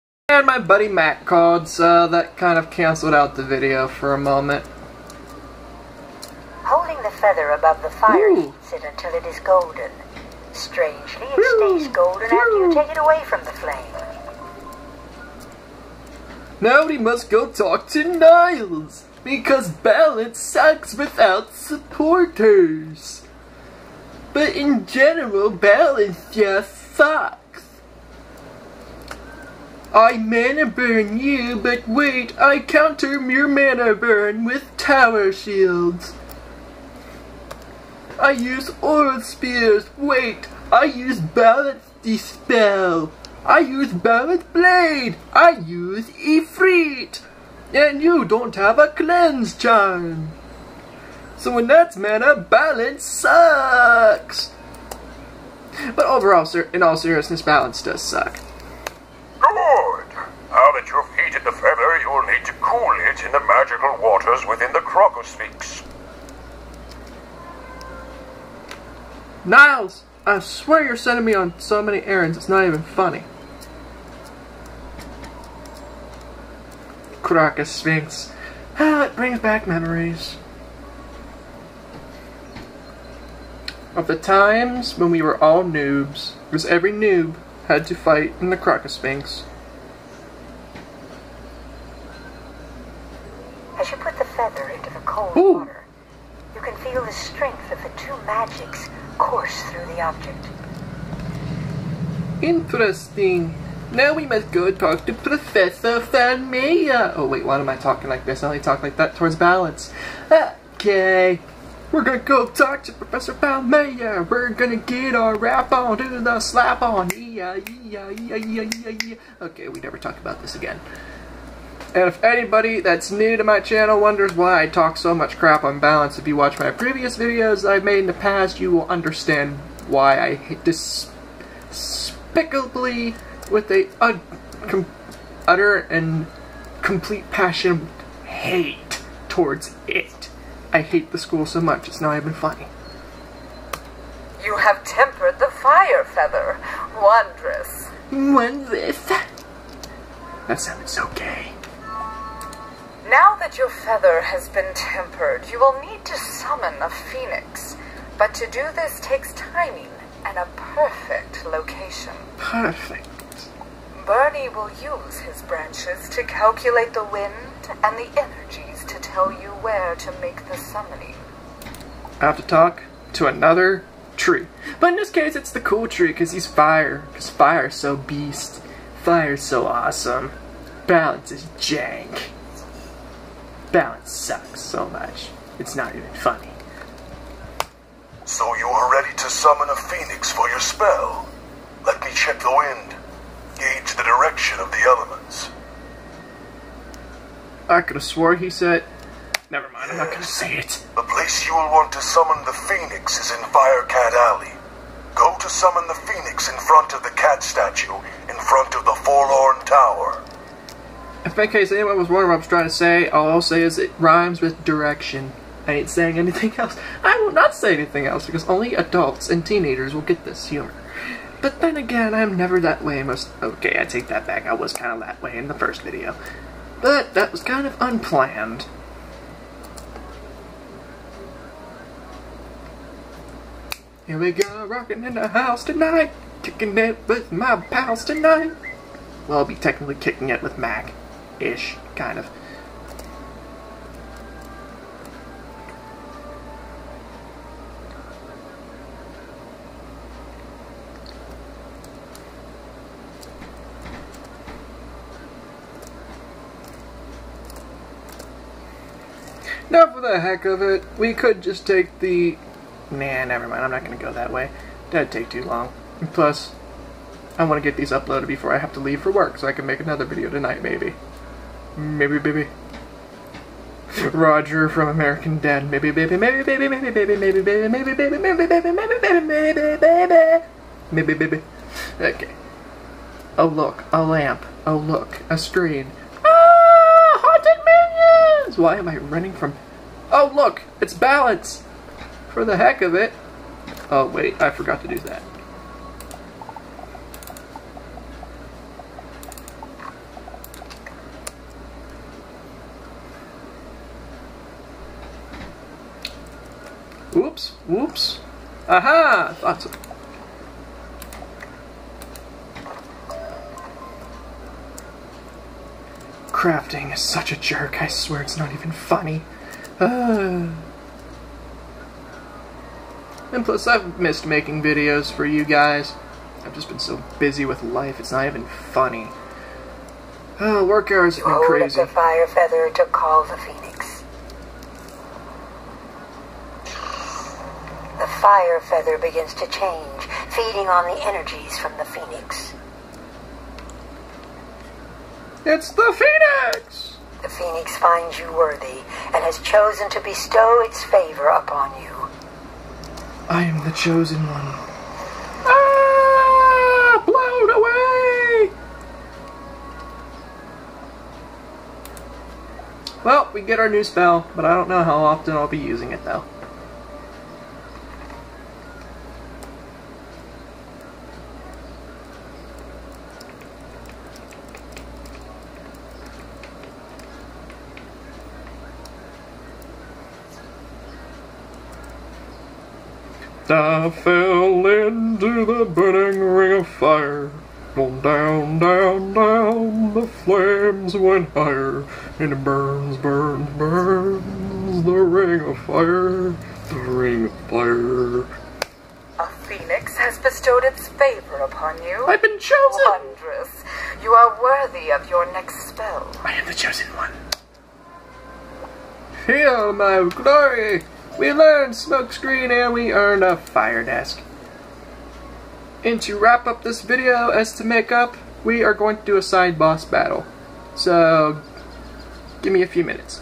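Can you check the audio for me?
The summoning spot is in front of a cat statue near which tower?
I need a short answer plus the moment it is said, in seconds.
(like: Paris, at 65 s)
Forlorn Tower, at 209 s.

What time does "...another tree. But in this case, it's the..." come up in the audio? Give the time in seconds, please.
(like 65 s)
173 s.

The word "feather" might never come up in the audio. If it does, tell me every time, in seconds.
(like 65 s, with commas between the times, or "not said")
7 s, 94 s, 146 s, 153 s, 332 s, 338 s.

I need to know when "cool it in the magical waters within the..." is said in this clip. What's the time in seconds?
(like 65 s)
62 s.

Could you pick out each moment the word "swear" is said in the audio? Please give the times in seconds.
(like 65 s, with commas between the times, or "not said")
70 s, 317 s.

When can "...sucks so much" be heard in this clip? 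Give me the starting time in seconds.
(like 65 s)
184 s.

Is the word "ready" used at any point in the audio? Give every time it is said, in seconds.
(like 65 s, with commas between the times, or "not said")
188 s.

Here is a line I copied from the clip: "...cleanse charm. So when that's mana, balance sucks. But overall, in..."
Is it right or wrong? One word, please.
right.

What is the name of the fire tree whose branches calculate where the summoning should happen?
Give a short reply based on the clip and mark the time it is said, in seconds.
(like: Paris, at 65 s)
Bernie, at 164 s.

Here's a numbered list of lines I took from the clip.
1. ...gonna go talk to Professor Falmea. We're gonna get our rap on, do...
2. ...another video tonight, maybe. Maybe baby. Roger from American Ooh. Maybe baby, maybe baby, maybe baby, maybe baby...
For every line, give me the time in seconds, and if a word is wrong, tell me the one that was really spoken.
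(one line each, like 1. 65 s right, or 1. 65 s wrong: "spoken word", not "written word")
1. 112 s right
2. 269 s wrong: "Dad", not "Ooh".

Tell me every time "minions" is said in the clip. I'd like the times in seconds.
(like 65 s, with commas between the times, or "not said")
287 s.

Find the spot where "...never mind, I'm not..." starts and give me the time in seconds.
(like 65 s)
263 s.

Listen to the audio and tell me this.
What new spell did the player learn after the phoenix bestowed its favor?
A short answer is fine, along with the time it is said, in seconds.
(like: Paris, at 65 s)
Smokescreen, at 411 s.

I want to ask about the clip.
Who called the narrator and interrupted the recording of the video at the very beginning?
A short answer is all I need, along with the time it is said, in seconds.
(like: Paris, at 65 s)
Matt, at 0 s.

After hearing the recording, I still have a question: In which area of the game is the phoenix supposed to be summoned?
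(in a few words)
Firecat Alley.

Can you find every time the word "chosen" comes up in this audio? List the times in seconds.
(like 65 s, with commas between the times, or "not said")
349 s, 353 s, 402 s, 406 s.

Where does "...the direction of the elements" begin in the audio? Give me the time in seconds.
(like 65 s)
193 s.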